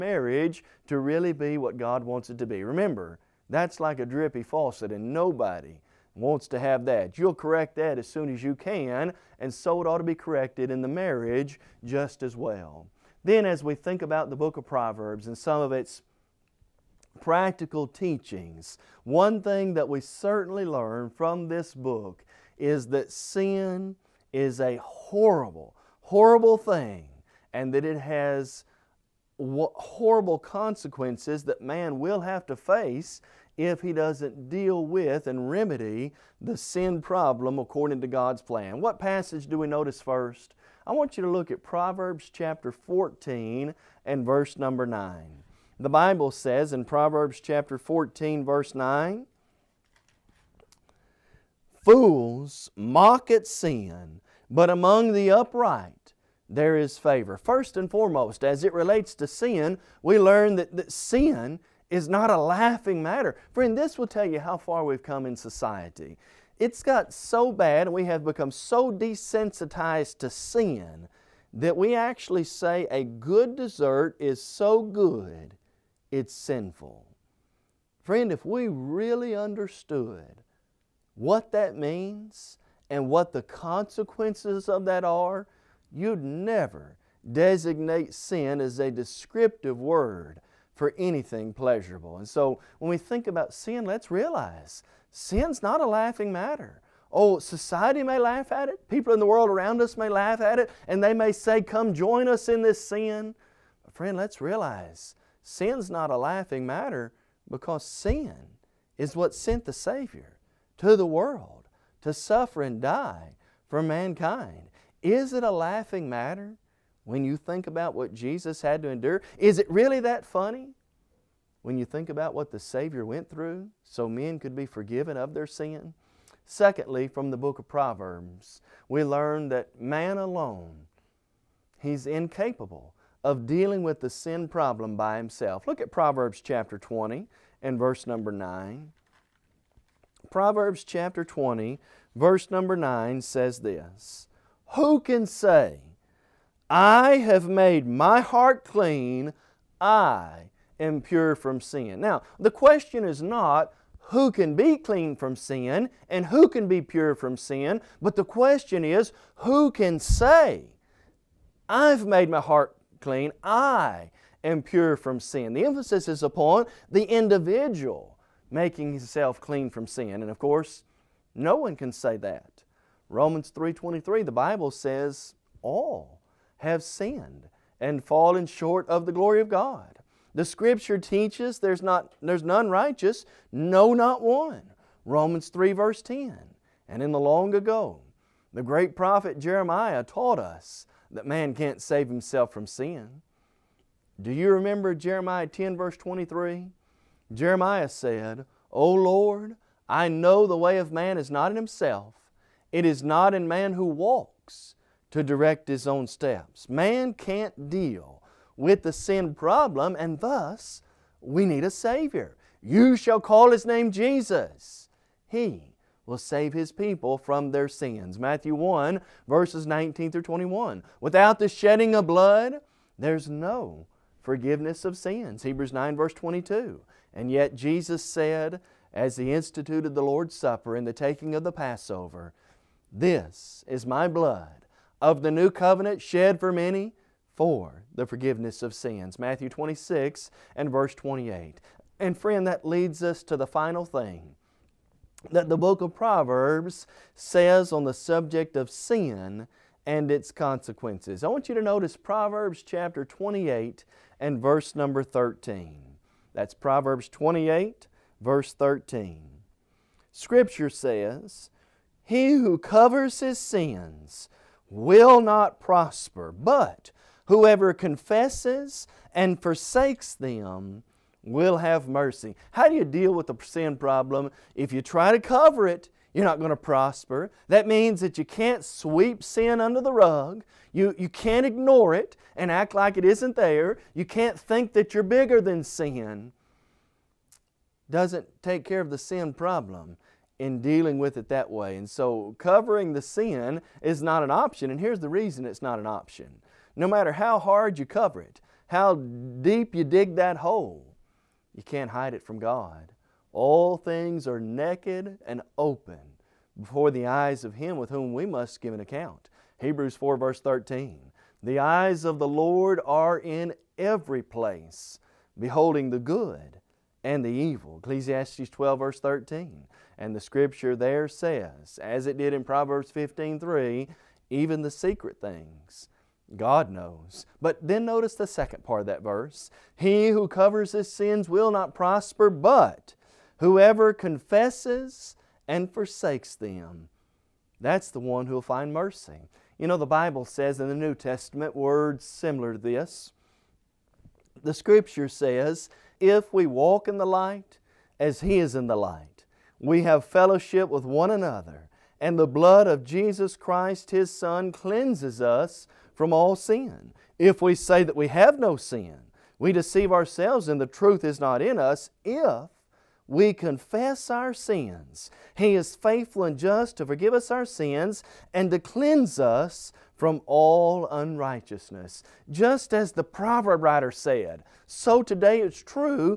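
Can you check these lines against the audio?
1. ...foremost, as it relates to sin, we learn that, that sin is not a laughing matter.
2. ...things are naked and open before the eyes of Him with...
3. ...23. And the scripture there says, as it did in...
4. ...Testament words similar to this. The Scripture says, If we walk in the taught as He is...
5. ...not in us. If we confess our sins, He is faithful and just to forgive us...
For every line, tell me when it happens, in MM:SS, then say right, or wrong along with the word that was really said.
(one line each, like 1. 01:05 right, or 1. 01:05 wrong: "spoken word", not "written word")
1. 00:57 right
2. 05:03 right
3. 05:18 wrong: "13", not "23"
4. 05:40 wrong: "light", not "taught"
5. 06:01 right.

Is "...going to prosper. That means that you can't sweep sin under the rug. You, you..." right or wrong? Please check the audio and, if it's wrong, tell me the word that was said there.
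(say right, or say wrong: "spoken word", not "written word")
right.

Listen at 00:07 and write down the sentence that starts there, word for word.
You'll correct that as soon as you can and so it ought to be corrected in the marriage just as well.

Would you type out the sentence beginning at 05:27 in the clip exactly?
But then notice the second part of that verse.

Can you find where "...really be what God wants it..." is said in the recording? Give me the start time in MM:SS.
00:00.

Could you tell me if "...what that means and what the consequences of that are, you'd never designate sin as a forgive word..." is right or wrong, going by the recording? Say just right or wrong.
wrong.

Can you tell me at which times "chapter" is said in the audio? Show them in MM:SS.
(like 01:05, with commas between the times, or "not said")
00:42, 00:47, 02:16, 02:20, 04:12.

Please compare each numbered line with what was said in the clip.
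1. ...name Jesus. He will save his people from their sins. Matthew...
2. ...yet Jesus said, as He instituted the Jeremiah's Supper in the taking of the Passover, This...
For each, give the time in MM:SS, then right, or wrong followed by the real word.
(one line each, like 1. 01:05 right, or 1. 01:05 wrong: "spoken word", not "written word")
1. 03:33 right
2. 03:47 wrong: "Lord", not "Jeremiah".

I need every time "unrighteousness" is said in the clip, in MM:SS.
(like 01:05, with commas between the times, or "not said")
06:10.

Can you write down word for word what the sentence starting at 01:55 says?
Is it a laughing matter when you think about what Jesus had to endure?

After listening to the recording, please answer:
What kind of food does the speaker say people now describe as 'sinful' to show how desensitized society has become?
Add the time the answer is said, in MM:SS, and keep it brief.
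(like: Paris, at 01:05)
dessert, at 01:13.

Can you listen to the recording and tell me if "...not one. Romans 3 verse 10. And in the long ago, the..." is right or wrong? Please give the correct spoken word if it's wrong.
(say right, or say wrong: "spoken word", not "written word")
right.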